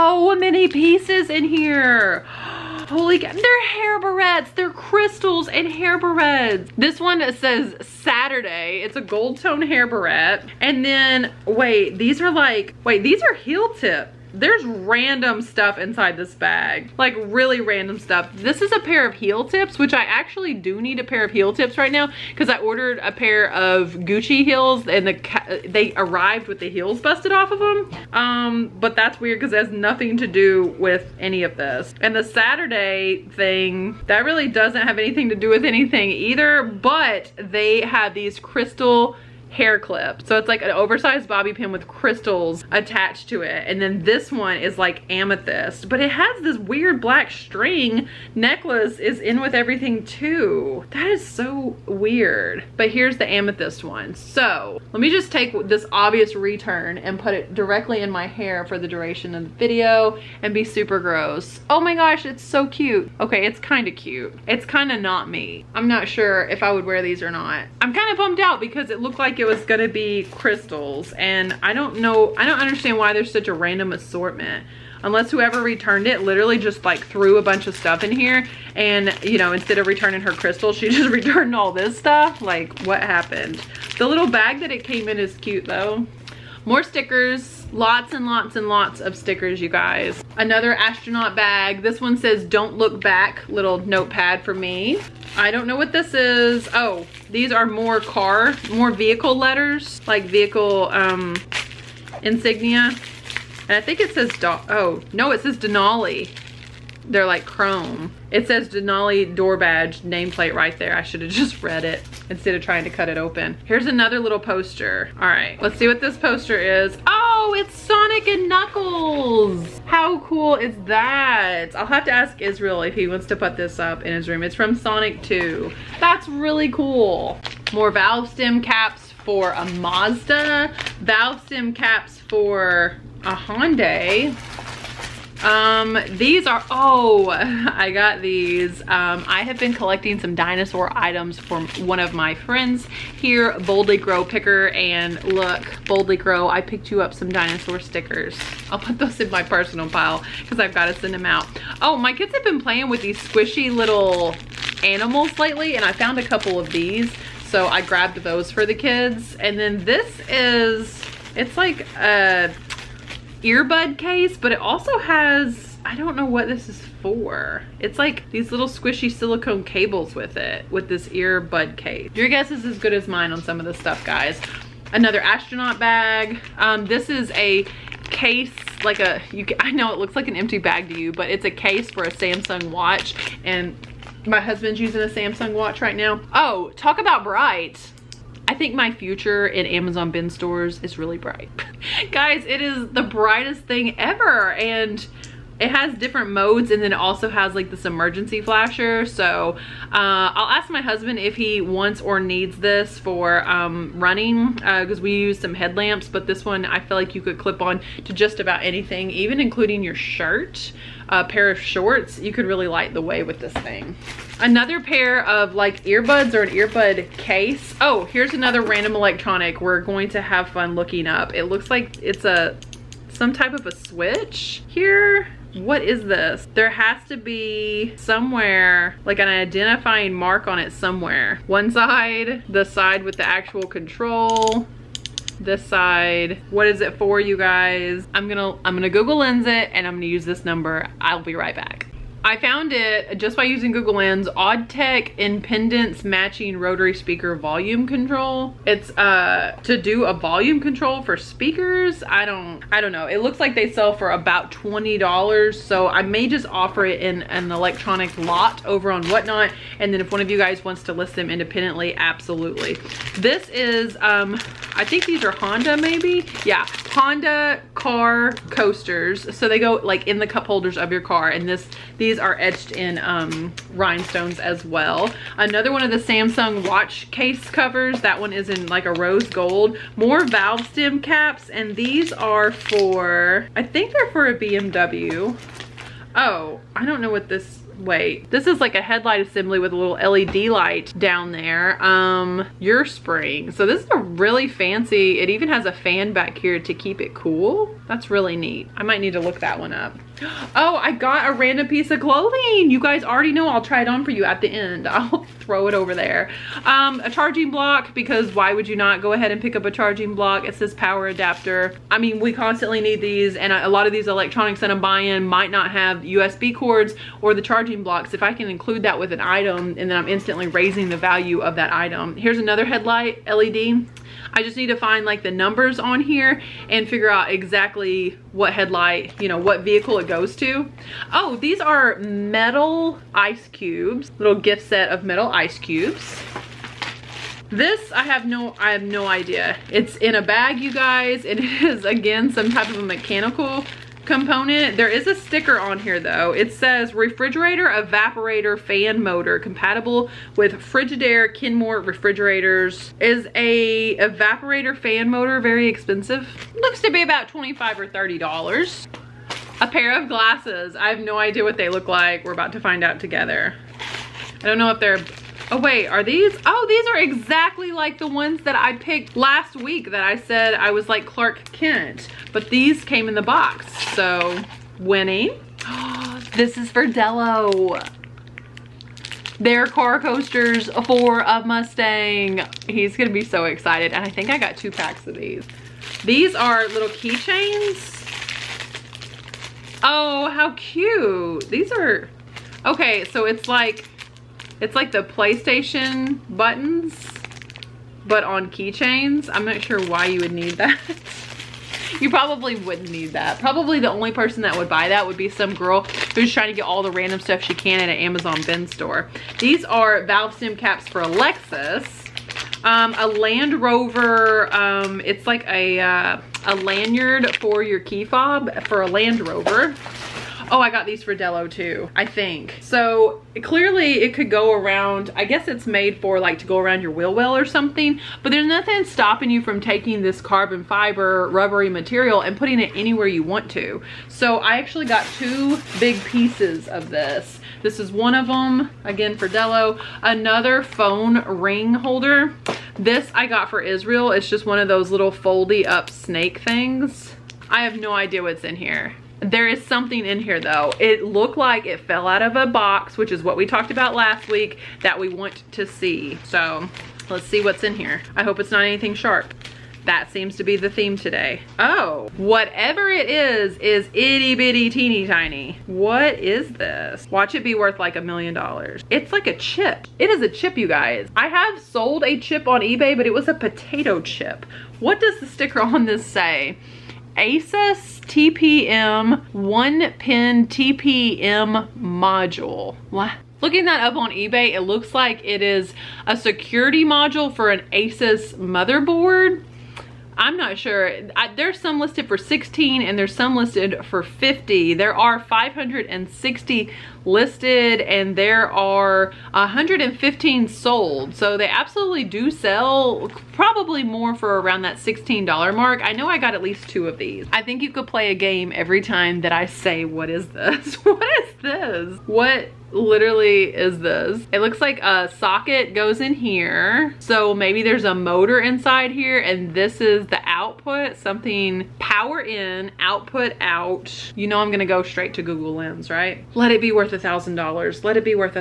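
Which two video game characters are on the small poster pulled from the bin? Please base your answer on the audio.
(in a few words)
Sonic and Knuckles.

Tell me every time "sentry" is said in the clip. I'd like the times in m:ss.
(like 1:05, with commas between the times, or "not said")
not said.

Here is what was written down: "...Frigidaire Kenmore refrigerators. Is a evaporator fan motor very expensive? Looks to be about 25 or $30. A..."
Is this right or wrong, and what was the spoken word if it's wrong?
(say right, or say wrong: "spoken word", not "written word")
right.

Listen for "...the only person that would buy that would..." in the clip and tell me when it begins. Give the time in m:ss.
6:43.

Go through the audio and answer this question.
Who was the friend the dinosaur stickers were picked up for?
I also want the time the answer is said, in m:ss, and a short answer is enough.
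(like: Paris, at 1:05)
Boldly Grow Picker, at 2:23.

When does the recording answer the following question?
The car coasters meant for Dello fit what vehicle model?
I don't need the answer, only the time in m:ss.
6:21.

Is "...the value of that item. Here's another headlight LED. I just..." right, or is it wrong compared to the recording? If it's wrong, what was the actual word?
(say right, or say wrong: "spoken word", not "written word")
right.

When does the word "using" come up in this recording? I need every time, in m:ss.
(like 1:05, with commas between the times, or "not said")
3:04, 4:03.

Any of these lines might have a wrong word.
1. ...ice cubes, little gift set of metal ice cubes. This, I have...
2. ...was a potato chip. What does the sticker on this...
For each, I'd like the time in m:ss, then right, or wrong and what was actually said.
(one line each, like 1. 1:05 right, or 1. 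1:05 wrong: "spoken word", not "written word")
1. 5:33 right
2. 7:53 right.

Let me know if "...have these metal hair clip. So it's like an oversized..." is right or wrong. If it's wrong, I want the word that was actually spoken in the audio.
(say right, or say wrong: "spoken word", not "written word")
wrong: "crystal", not "metal".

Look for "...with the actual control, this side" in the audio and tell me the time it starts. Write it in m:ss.
3:53.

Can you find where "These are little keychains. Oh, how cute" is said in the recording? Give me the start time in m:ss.
6:26.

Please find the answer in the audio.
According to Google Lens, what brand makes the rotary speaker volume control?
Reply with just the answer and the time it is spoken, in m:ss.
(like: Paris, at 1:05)
Audtech, at 4:04.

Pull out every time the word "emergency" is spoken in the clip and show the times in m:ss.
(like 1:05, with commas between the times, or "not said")
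3:17.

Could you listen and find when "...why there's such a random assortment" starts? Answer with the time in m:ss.
1:12.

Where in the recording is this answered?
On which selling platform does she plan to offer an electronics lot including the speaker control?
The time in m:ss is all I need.
4:19.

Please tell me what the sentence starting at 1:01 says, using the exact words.
Oh my gosh, it's so cute.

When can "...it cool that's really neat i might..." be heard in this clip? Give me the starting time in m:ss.
4:57.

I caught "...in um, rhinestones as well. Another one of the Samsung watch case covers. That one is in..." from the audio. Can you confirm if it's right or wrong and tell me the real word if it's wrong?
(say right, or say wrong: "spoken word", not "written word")
right.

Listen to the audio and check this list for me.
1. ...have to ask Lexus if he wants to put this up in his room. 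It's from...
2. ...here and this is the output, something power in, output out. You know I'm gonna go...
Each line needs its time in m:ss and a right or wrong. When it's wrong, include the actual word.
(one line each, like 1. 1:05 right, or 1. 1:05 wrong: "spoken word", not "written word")
1. 2:01 wrong: "Israel", not "Lexus"
2. 8:38 right.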